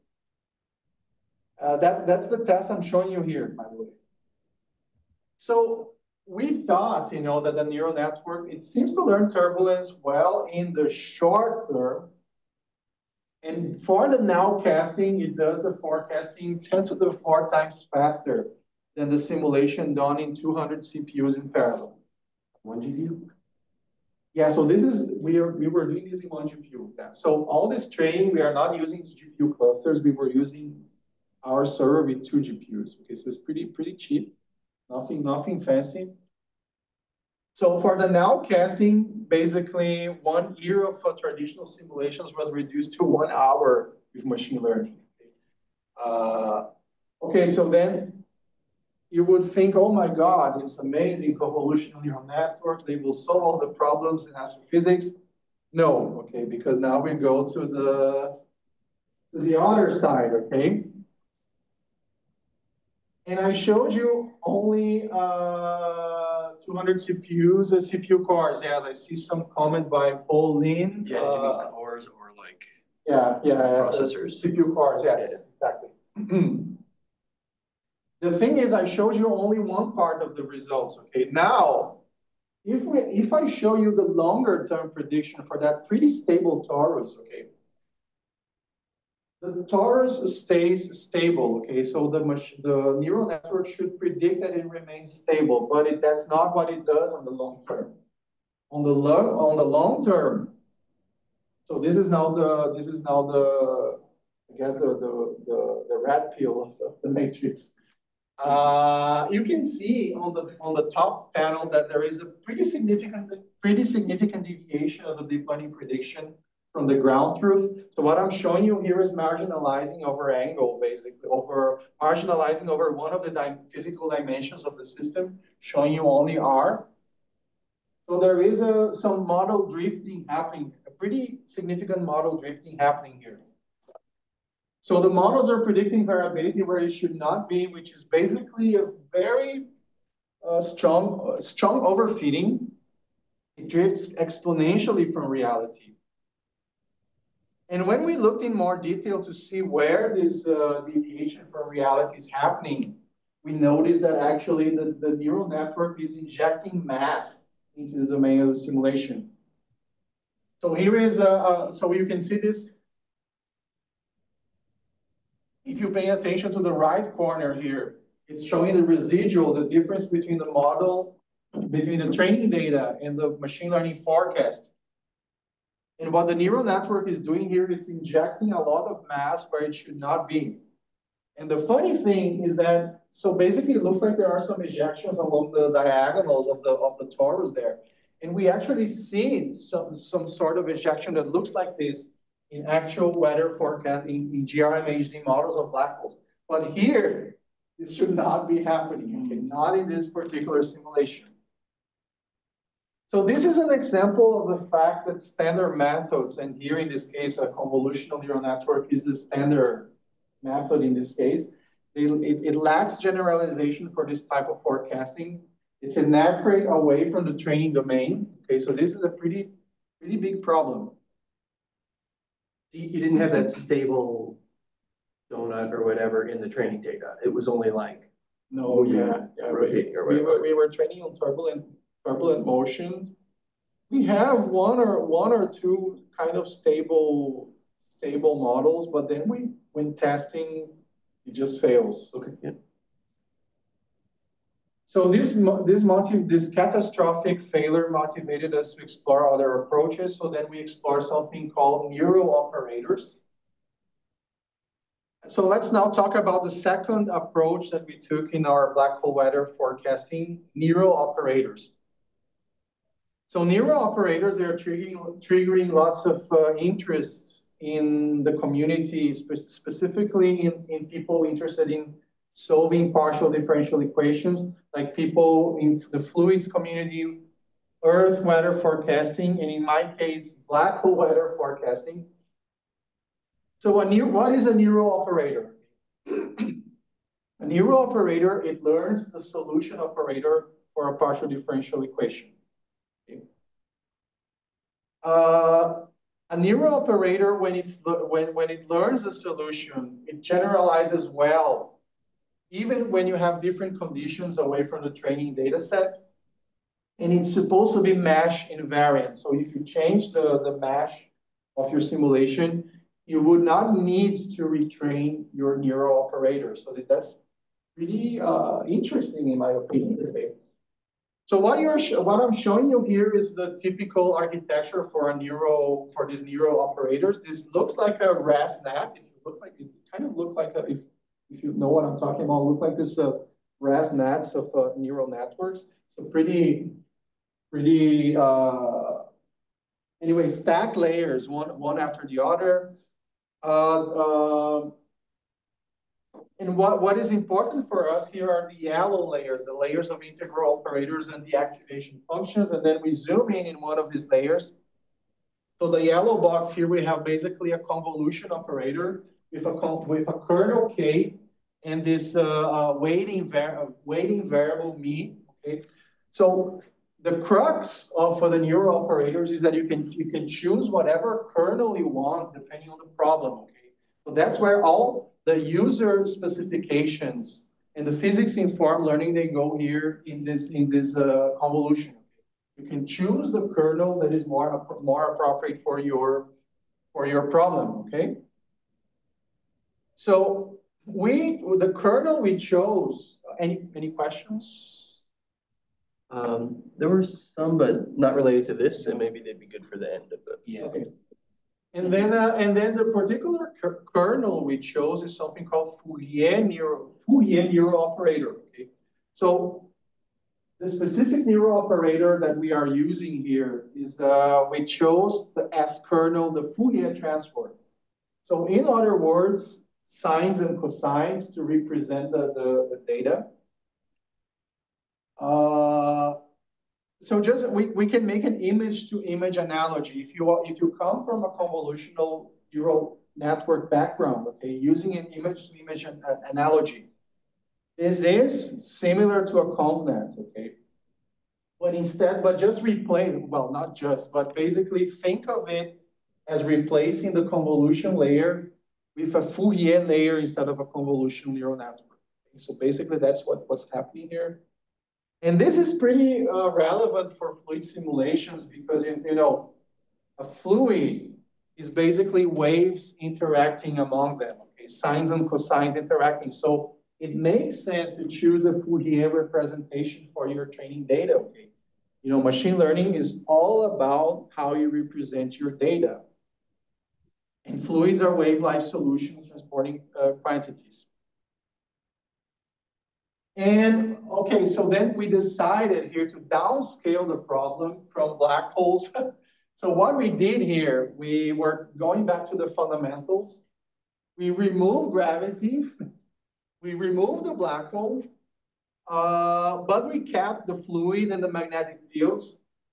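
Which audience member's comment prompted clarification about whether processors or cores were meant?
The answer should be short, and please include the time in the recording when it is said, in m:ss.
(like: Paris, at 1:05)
Paul Lin, at 1:10.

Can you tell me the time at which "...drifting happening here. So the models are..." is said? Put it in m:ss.
2:12.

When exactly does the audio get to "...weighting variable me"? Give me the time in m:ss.
6:03.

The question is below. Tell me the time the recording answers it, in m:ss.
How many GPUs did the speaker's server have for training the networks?
0:32.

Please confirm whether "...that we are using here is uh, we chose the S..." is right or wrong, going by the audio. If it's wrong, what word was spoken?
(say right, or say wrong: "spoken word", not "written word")
right.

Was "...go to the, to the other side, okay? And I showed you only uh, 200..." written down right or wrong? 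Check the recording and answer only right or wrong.
right.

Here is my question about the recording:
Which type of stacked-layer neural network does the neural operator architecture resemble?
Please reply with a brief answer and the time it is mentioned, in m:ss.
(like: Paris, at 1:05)
ResNet, at 5:28.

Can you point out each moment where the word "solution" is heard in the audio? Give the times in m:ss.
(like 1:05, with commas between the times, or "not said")
4:49, 4:59, 7:58.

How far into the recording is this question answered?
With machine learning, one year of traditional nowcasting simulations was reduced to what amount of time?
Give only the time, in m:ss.
0:43.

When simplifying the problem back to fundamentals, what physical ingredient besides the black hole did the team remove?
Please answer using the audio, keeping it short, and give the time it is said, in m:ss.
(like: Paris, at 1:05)
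gravity, at 8:14.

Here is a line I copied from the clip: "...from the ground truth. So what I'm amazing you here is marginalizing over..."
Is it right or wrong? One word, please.
wrong.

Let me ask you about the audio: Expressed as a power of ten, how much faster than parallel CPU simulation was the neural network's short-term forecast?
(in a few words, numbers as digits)
10^4.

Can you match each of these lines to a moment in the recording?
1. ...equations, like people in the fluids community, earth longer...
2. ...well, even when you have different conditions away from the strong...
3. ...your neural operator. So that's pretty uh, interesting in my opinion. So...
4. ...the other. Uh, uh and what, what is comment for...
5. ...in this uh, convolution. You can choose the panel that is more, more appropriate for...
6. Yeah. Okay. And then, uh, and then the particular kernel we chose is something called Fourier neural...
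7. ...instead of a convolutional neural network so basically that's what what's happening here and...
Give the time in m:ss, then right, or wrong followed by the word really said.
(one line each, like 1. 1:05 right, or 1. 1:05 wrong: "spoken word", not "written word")
1. 4:33 wrong: "weather", not "longer"
2. 5:01 wrong: "training", not "strong"
3. 5:15 right
4. 5:42 wrong: "important", not "comment"
5. 6:20 wrong: "kernel", not "panel"
6. 6:40 right
7. 7:30 right.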